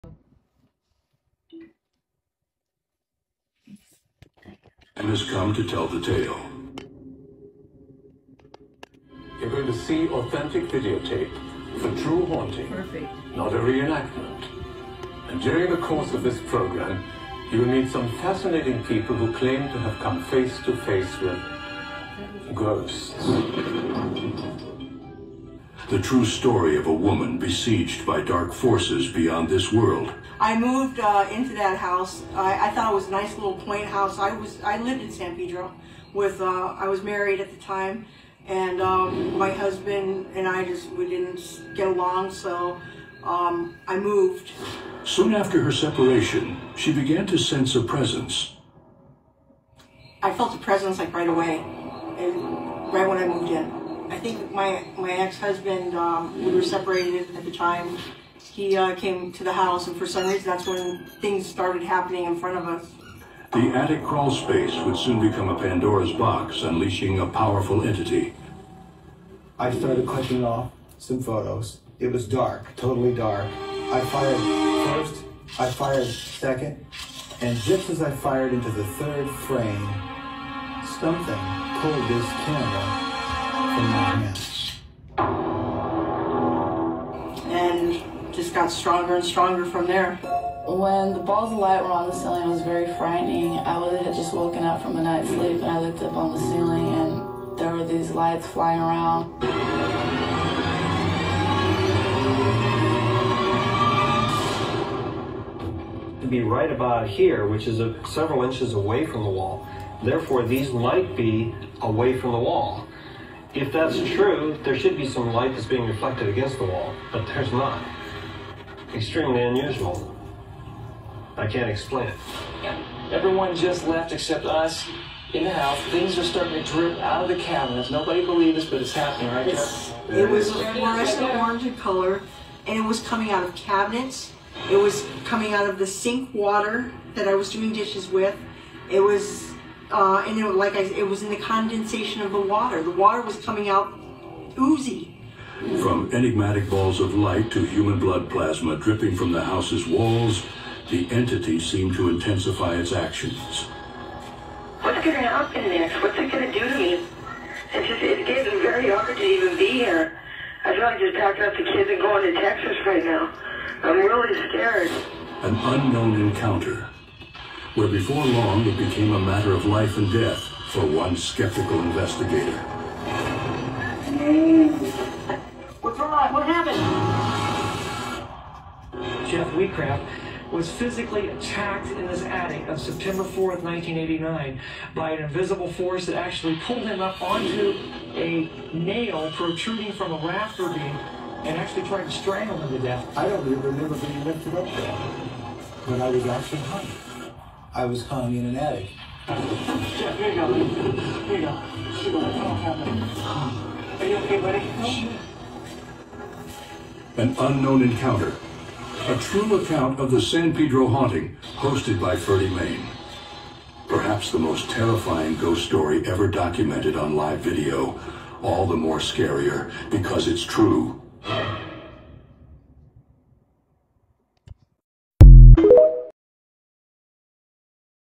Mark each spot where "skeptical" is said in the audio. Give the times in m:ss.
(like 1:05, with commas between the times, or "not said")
2:51.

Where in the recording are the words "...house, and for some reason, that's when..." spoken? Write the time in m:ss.
0:59.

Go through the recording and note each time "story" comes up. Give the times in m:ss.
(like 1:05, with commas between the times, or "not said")
0:26, 3:35.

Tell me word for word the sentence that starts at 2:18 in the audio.
It was uh, and it, like I, it was in the condensation of the water.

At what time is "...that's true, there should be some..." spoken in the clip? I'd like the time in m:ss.
1:53.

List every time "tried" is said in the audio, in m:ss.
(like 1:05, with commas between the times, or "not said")
3:11.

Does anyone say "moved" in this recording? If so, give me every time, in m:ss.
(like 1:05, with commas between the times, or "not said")
0:30, 0:43, 0:53.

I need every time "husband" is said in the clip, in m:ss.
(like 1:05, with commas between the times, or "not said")
0:39, 0:55.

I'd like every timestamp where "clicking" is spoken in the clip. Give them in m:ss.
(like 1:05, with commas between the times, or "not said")
1:10.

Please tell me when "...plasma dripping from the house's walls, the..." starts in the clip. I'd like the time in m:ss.
2:28.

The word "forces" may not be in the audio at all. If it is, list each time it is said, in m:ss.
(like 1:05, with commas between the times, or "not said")
0:28, 3:05.